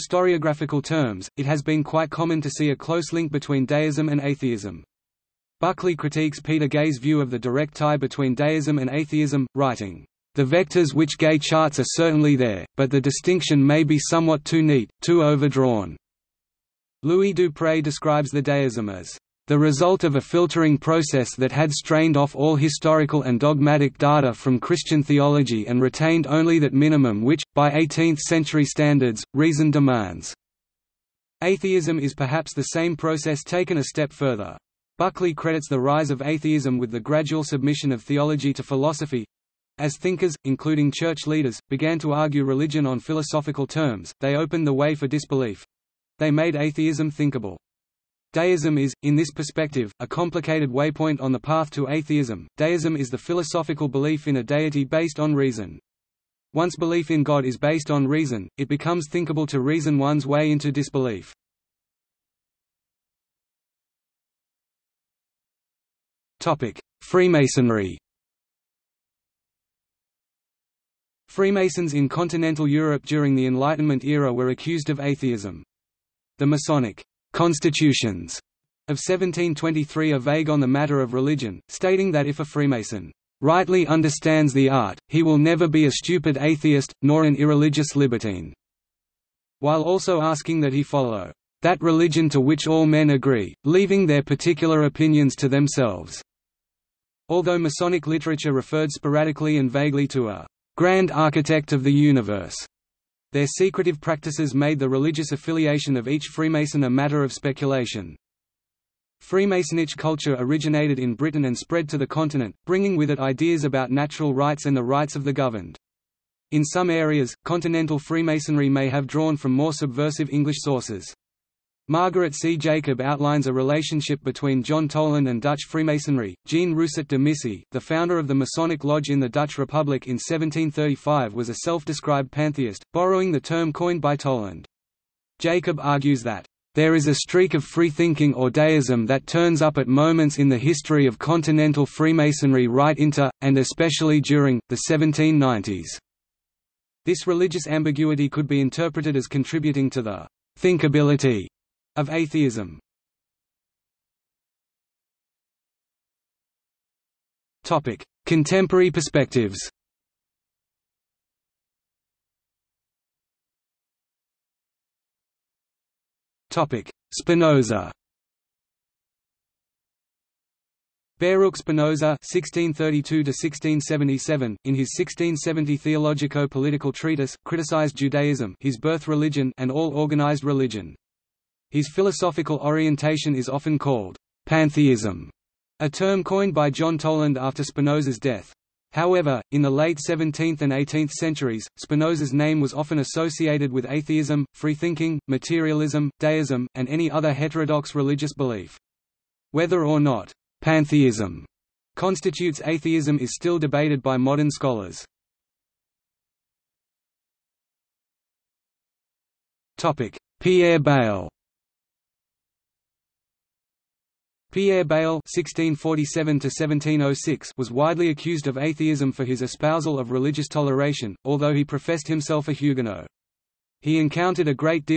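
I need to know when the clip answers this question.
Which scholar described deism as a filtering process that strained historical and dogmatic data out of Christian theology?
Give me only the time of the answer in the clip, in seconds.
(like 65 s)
17 s.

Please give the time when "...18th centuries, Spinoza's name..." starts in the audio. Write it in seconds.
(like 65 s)
190 s.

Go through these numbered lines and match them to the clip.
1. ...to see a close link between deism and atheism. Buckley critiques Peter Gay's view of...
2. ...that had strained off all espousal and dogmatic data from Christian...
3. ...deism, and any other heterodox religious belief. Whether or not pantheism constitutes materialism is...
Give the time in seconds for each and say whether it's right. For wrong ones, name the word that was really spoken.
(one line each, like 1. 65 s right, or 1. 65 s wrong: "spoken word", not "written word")
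1. 2 s right
2. 21 s wrong: "historical", not "espousal"
3. 196 s wrong: "atheism", not "materialism".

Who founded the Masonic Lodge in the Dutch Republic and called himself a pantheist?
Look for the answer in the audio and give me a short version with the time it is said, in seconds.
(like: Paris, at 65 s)
Jean Rousset de Missy, at 126 s.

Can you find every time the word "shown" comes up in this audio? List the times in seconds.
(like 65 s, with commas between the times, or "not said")
not said.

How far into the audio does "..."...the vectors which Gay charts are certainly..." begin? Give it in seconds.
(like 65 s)
10 s.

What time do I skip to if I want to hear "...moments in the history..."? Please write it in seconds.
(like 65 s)
139 s.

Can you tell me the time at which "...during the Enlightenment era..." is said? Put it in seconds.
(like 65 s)
73 s.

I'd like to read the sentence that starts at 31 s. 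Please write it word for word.
Atheism is perhaps the same process taken a step further.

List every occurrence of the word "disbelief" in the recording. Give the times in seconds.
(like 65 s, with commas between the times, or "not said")
45 s, 60 s.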